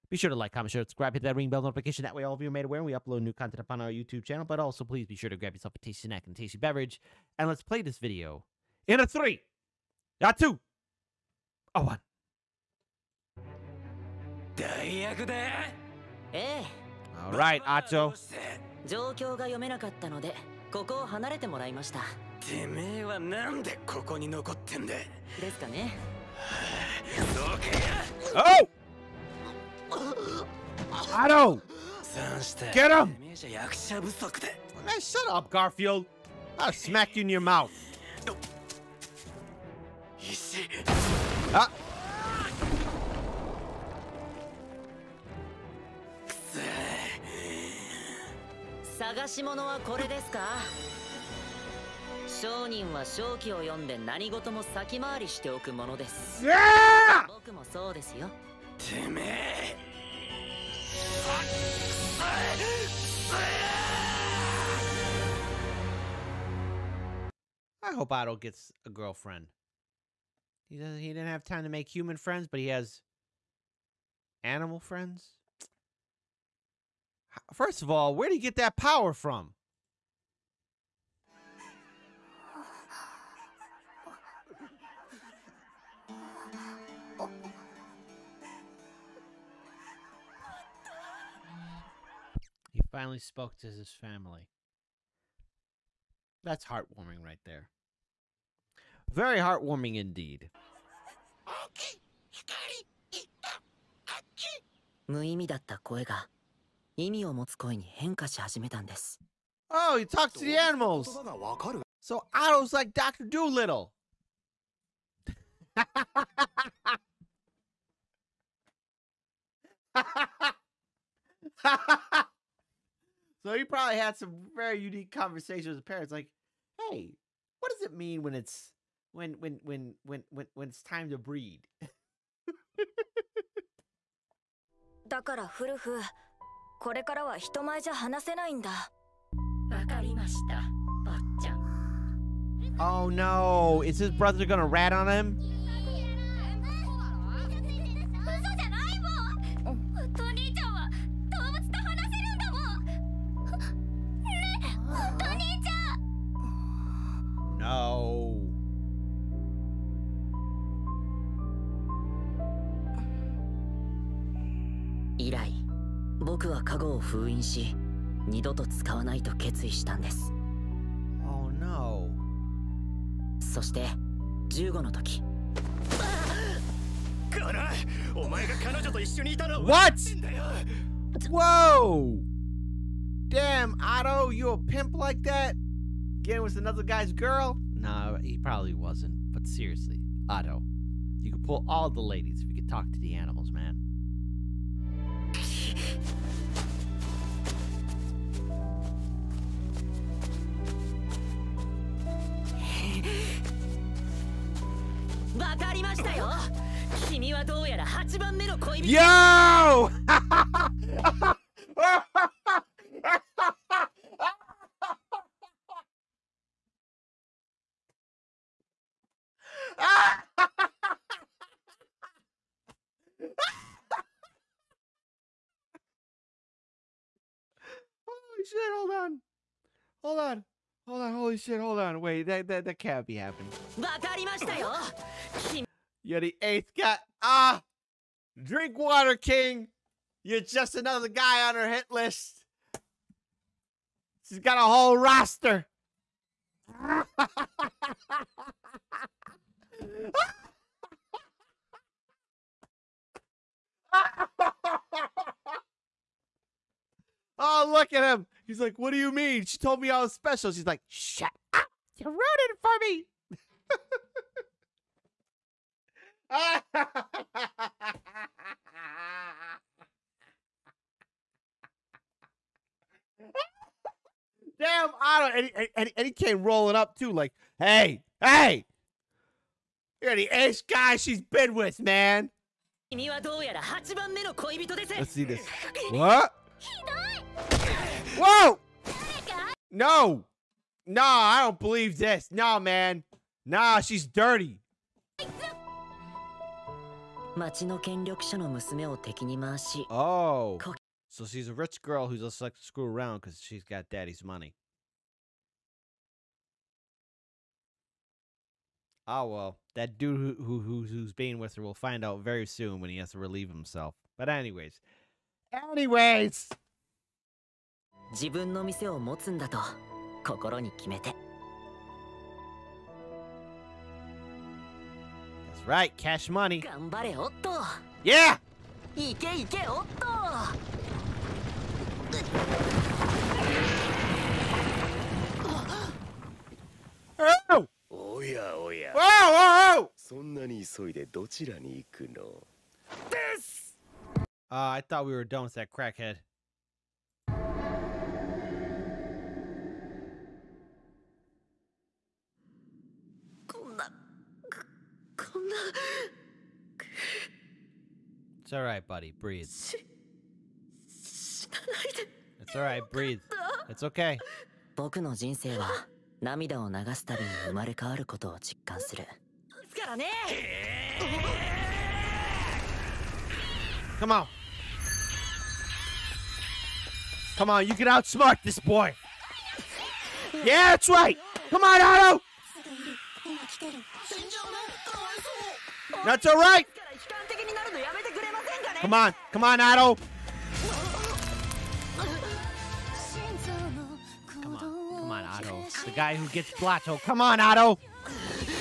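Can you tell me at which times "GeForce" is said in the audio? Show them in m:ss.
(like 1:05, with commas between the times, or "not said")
not said.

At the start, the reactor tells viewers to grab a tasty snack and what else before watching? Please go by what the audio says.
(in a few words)
tasty beverage.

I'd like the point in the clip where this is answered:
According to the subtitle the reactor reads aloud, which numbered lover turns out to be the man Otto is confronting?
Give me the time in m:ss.
3:56.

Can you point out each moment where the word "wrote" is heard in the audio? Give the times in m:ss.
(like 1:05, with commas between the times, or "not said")
4:22.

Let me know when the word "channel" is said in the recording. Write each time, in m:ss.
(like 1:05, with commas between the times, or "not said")
0:04.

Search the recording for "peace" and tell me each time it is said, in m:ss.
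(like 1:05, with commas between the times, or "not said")
not said.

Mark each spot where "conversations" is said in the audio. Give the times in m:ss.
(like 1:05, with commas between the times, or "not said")
2:05.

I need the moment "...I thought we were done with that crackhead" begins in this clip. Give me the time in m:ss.
5:44.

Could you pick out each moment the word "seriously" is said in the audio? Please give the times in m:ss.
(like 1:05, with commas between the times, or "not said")
3:09.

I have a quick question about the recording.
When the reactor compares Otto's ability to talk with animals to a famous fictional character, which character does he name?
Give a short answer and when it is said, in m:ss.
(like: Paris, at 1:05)
Dr. Doolittle, at 1:52.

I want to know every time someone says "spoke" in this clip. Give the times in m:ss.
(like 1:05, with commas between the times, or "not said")
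1:33.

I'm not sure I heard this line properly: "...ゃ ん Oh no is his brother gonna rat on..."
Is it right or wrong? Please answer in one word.
right.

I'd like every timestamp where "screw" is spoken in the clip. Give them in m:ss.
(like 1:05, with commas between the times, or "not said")
5:02.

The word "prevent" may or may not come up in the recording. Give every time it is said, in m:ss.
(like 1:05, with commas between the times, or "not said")
not said.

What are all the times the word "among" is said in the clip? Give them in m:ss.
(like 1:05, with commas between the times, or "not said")
not said.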